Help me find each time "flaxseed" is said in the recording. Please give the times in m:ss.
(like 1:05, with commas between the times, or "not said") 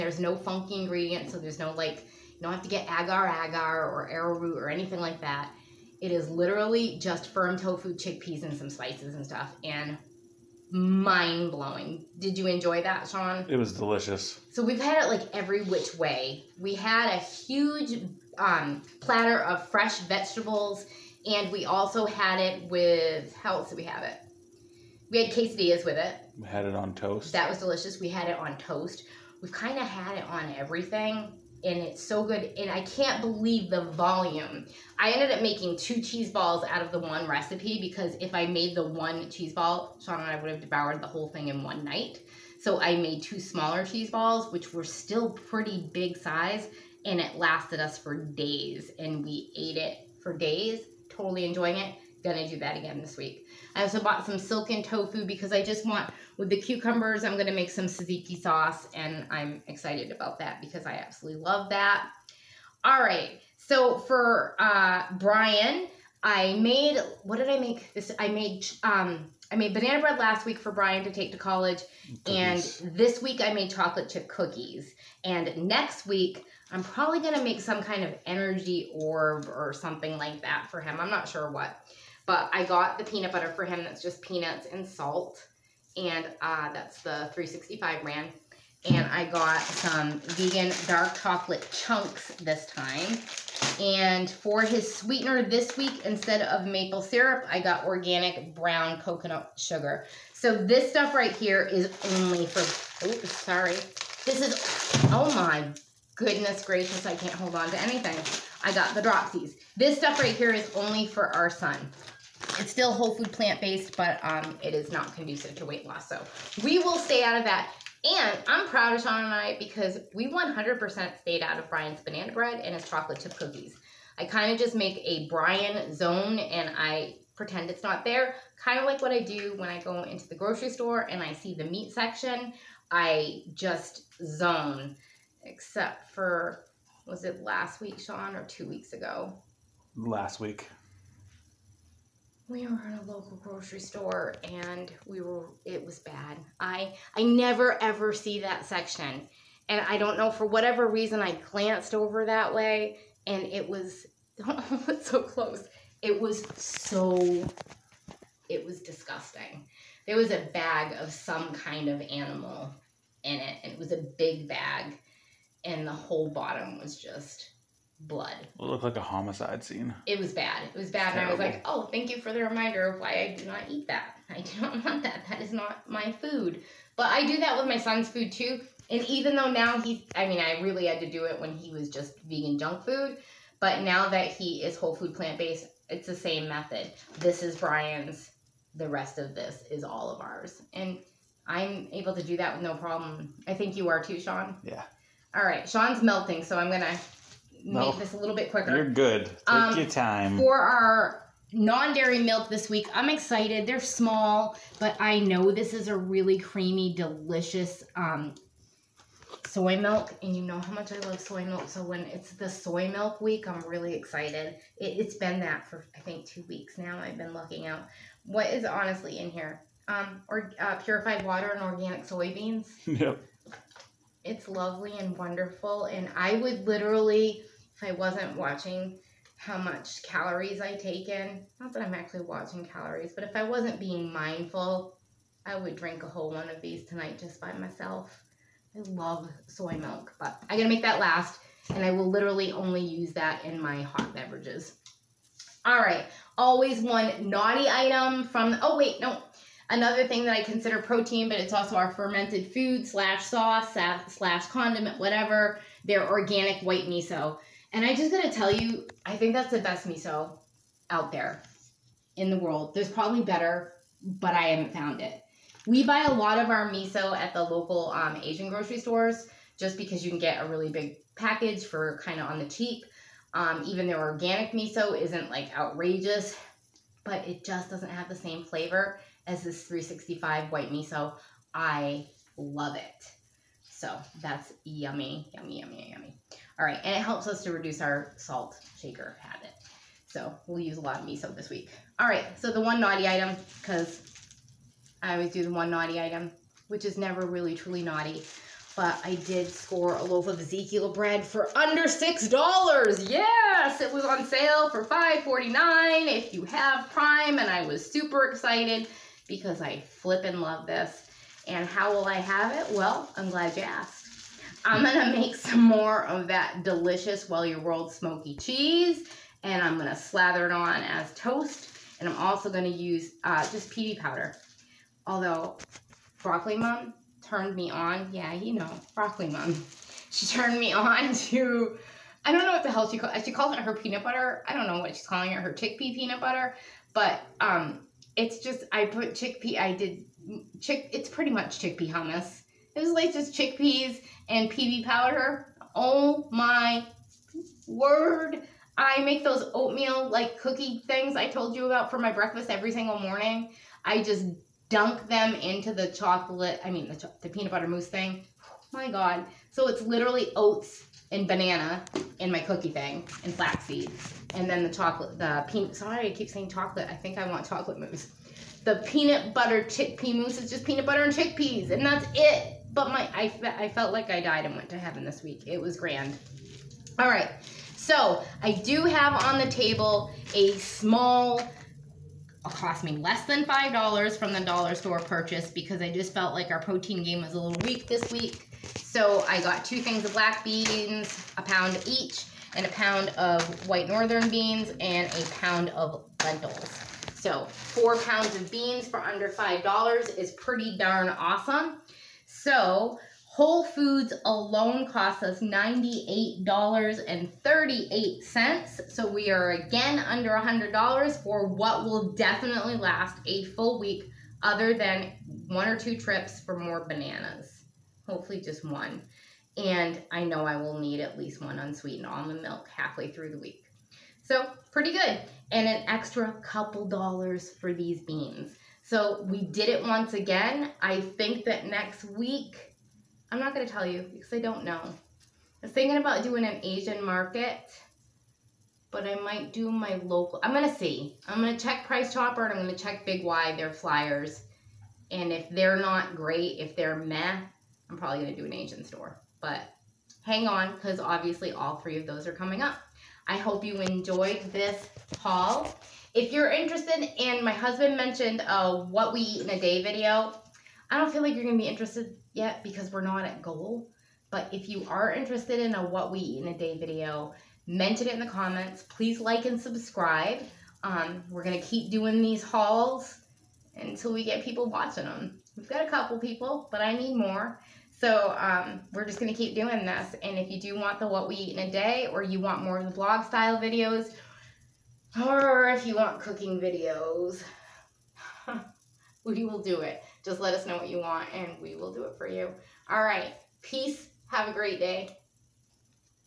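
6:03.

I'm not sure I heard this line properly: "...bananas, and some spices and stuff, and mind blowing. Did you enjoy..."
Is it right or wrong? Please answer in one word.
wrong.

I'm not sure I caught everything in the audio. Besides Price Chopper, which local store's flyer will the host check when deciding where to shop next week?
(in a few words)
Big Y.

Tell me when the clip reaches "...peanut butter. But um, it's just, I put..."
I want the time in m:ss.
5:35.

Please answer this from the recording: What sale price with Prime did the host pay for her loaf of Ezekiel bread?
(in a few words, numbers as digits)
$5.49.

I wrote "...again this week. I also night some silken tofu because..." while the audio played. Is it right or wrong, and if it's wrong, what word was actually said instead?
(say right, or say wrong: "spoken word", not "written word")
wrong: "bought", not "night".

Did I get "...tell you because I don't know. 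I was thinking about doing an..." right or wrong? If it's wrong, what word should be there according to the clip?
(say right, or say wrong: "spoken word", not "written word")
right.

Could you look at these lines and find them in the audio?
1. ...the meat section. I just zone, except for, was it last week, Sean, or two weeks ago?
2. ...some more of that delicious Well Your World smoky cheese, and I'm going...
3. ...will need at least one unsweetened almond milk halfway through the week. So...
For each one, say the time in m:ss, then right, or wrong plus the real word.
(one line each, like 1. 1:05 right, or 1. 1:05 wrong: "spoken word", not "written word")
1. 2:11 right
2. 5:15 right
3. 7:00 right.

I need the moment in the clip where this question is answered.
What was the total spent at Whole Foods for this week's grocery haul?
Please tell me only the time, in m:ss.
6:45.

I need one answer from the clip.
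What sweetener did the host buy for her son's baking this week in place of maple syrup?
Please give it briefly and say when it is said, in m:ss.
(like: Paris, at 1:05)
organic brown coconut sugar, at 1:37.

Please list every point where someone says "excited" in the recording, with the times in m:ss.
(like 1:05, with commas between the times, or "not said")
0:59, 3:23, 3:33, 5:08.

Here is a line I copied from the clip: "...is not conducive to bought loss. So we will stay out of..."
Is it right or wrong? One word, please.
wrong.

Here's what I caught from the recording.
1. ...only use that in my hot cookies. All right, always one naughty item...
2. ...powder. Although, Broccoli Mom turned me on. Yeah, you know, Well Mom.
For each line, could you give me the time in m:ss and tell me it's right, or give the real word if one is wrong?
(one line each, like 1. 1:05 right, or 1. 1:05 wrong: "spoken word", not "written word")
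1. 4:02 wrong: "beverages", not "cookies"
2. 5:23 wrong: "Broccoli", not "Well".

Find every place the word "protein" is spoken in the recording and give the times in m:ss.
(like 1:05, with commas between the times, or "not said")
4:10, 6:26.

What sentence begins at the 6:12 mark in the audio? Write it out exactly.
But my, I, I felt like I died and went to heaven this week.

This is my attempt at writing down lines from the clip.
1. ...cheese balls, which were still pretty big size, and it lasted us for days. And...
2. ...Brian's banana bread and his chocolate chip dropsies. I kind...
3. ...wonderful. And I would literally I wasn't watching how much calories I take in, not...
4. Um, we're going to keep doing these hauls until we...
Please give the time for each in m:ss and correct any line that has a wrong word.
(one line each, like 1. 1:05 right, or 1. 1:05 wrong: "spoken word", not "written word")
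1. 0:43 right
2. 2:01 wrong: "cookies", not "dropsies"
3. 3:45 right
4. 7:50 right.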